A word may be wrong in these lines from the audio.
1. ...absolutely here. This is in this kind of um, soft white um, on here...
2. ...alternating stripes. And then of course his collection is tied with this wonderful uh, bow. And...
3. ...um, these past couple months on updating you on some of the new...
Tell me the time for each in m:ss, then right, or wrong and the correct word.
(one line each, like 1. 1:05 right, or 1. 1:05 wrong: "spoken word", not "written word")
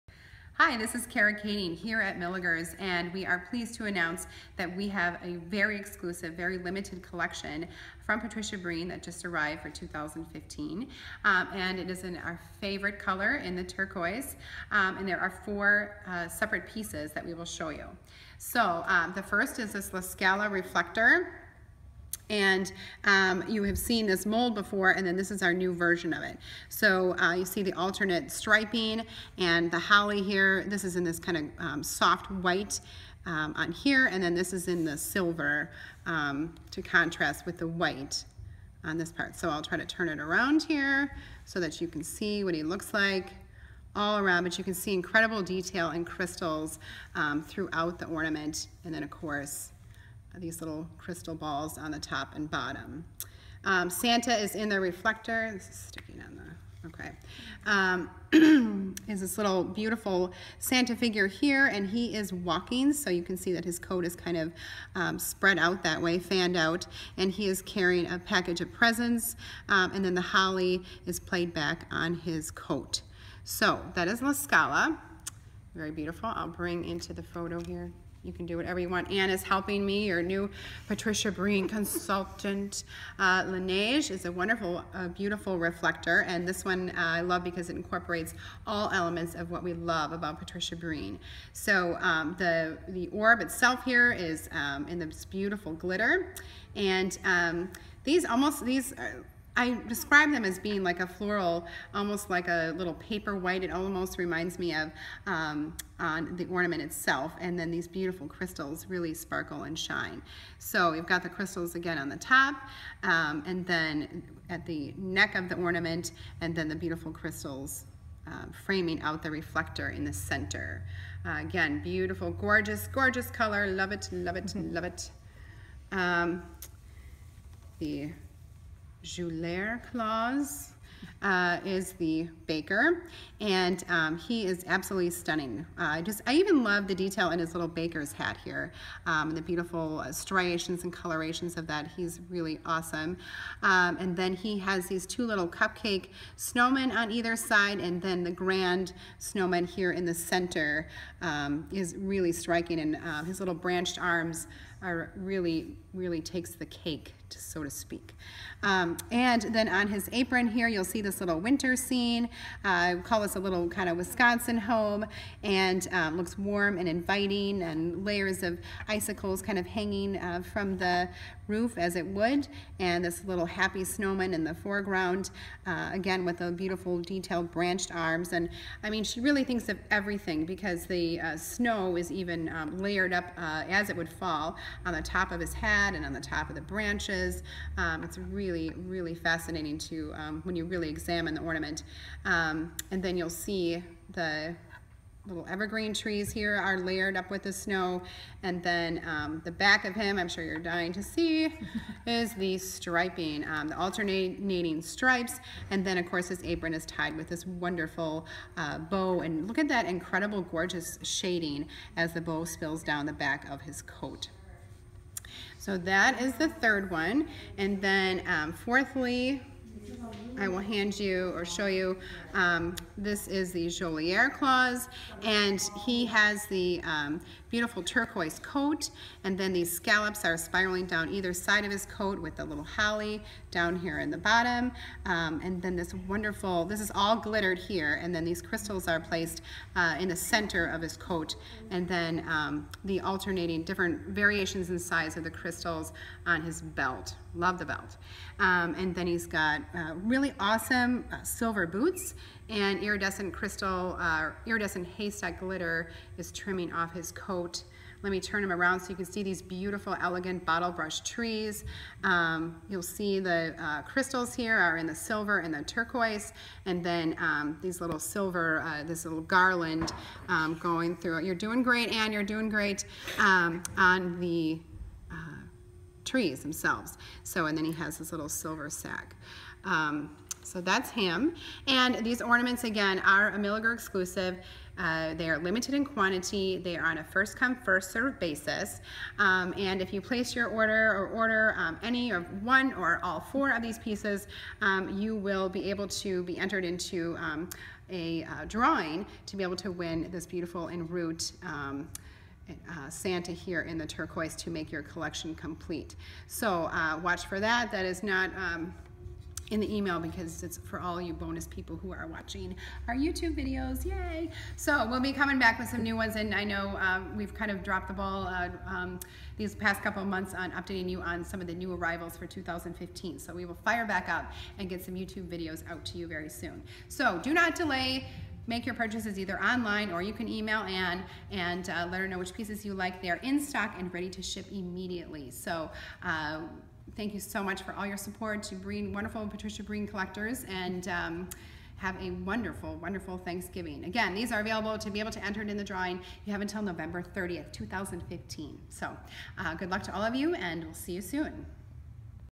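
1. 0:29 wrong: "holly", not "absolutely"
2. 3:23 wrong: "apron", not "collection"
3. 5:18 right.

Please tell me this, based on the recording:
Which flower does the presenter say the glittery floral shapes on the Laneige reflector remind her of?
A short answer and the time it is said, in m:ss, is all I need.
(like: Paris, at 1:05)
paper white, at 1:42.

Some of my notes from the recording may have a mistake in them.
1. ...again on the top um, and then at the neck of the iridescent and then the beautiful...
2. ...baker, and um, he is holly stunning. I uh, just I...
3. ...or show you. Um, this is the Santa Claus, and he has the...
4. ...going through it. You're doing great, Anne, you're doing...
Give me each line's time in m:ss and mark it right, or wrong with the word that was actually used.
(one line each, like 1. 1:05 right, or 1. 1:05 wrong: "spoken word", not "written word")
1. 1:51 wrong: "ornament", not "iridescent"
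2. 2:12 wrong: "absolutely", not "holly"
3. 3:41 wrong: "Joliere", not "Santa"
4. 4:30 right.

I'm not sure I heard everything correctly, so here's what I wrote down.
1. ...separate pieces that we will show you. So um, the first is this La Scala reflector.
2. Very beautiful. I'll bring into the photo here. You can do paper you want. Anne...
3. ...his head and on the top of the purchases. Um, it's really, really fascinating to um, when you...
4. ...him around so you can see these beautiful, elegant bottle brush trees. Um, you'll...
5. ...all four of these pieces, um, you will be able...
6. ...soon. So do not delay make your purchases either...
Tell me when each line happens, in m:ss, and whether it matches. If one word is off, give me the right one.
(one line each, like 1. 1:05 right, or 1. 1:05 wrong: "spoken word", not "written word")
1. 0:16 right
2. 1:15 wrong: "whatever", not "paper"
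3. 3:05 wrong: "branches", not "purchases"
4. 4:18 right
5. 4:53 right
6. 5:26 right.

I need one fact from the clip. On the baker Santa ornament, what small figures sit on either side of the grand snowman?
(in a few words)
cupcake snowmen.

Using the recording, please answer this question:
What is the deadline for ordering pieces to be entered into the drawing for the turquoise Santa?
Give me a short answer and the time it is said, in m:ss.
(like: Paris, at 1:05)
November 30th, 2015, at 5:46.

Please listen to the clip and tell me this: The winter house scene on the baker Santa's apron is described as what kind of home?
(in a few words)
Wisconsin home.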